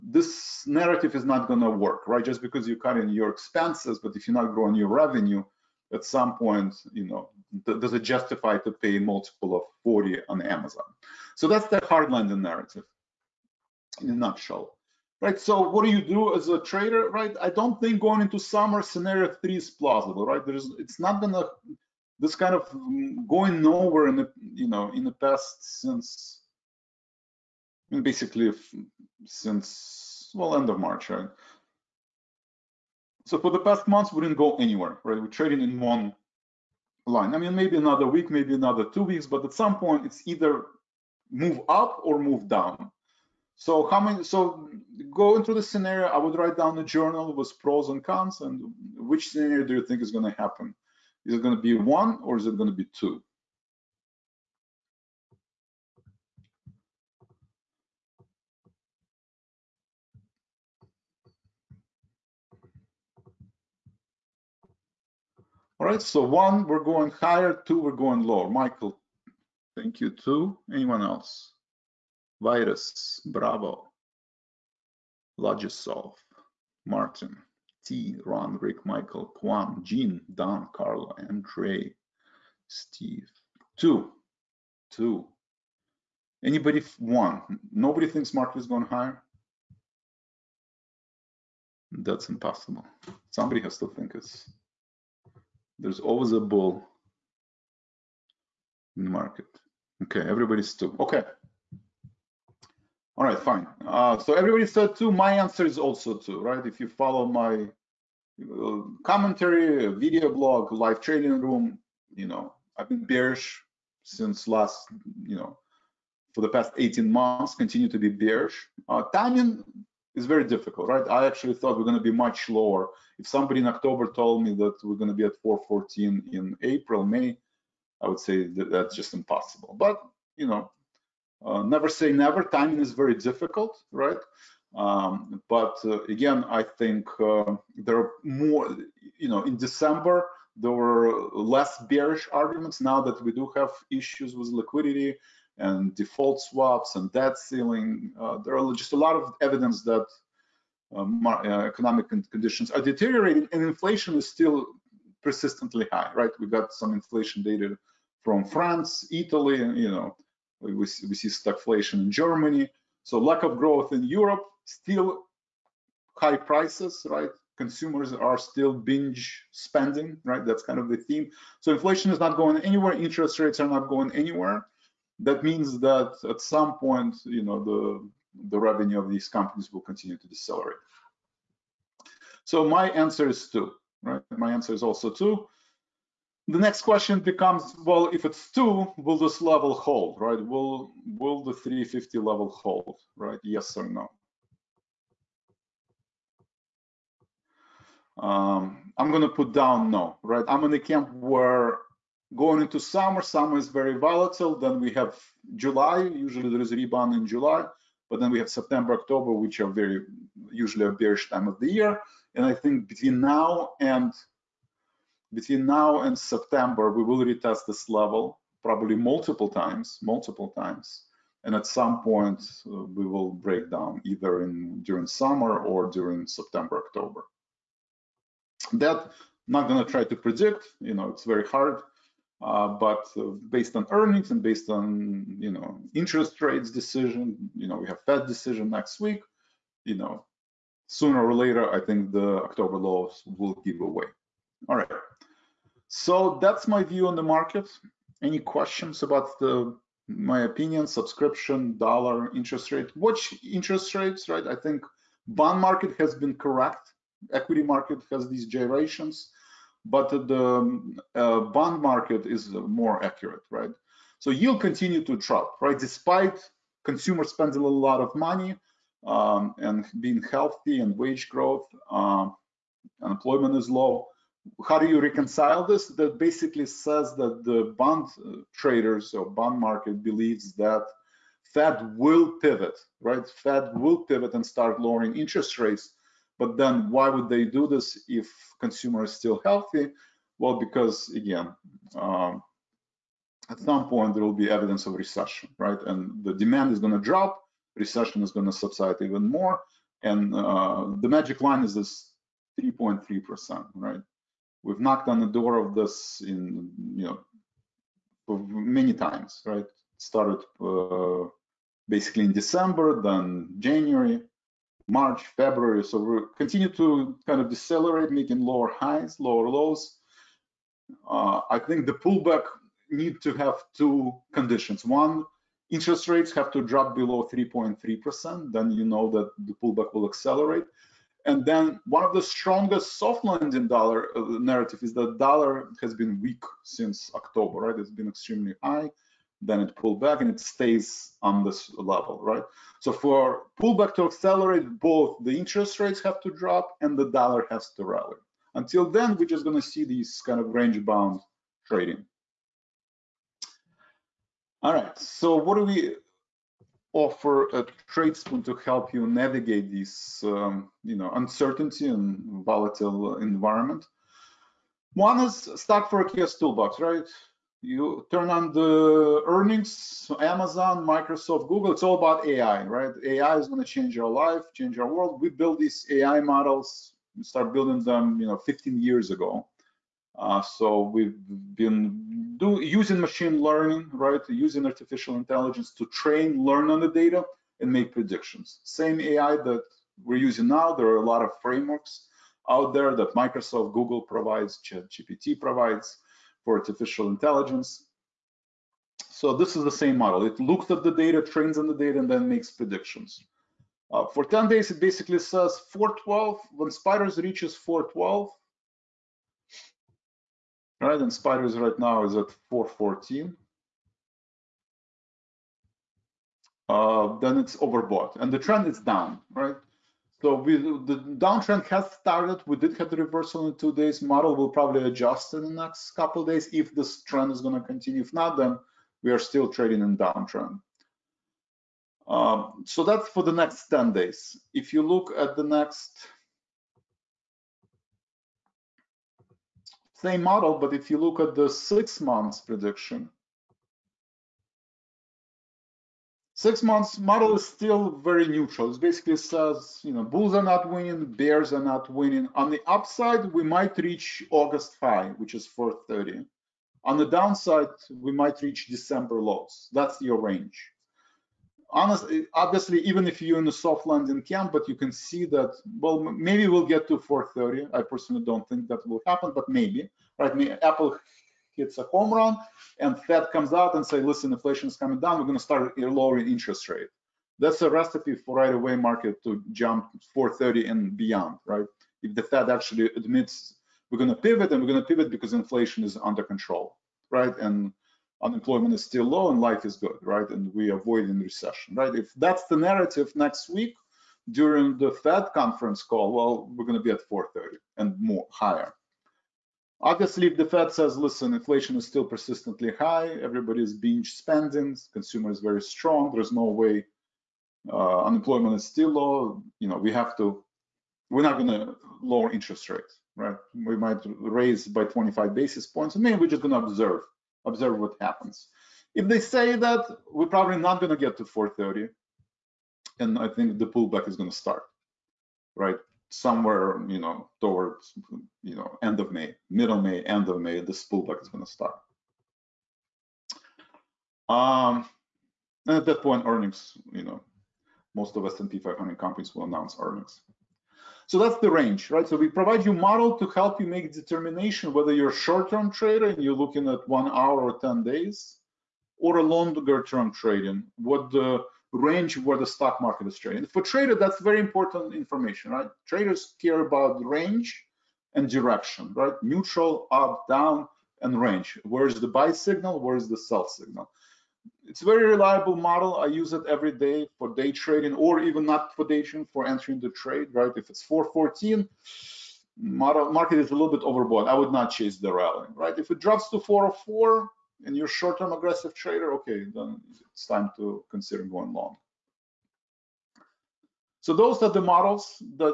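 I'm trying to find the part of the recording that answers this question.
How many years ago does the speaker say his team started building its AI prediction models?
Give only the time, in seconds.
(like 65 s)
378 s.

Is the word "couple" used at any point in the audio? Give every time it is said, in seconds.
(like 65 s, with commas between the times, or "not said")
425 s.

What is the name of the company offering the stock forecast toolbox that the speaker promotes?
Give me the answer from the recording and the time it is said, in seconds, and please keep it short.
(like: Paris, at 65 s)
TradeSpoon, at 357 s.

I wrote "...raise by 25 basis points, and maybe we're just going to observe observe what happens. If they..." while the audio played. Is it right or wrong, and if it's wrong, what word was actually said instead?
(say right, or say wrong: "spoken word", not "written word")
right.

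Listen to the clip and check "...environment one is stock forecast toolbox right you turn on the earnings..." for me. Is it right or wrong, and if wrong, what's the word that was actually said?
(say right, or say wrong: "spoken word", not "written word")
right.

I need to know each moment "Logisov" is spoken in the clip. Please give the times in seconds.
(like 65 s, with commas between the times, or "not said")
75 s.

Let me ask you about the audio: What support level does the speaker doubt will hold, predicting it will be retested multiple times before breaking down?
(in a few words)
350.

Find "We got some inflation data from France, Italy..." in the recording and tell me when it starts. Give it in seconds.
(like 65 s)
156 s.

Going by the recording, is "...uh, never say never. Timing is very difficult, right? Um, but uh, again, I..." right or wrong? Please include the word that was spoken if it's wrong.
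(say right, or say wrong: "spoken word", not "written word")
right.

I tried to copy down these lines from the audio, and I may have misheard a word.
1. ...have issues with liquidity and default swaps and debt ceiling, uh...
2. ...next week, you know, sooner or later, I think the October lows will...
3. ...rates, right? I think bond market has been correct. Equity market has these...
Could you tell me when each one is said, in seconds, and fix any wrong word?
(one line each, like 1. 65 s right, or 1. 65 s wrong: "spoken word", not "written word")
1. 143 s right
2. 238 s right
3. 253 s right.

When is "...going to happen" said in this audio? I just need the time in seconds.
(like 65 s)
50 s.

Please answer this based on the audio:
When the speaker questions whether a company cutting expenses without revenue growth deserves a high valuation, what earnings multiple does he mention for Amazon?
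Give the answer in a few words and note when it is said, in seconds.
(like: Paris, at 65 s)
40, at 8 s.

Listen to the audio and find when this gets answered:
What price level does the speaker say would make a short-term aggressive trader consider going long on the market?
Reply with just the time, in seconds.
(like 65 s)
576 s.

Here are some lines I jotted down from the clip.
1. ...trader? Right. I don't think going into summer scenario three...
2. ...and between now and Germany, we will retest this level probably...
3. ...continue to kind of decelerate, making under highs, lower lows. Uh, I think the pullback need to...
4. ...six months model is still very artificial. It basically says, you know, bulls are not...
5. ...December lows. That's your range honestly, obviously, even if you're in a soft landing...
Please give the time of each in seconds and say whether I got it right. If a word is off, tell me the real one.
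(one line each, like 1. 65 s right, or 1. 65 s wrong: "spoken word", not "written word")
1. 16 s right
2. 213 s wrong: "September", not "Germany"
3. 316 s wrong: "lower", not "under"
4. 446 s wrong: "neutral", not "artificial"
5. 458 s right.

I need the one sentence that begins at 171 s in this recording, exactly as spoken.
So inflation is not going anywhere.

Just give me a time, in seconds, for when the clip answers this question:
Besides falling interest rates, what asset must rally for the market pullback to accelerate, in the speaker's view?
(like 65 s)
347 s.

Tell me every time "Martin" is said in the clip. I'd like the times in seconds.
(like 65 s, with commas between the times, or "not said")
76 s.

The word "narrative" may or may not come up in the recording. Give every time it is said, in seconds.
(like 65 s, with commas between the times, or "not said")
0 s, 12 s, 334 s, 492 s.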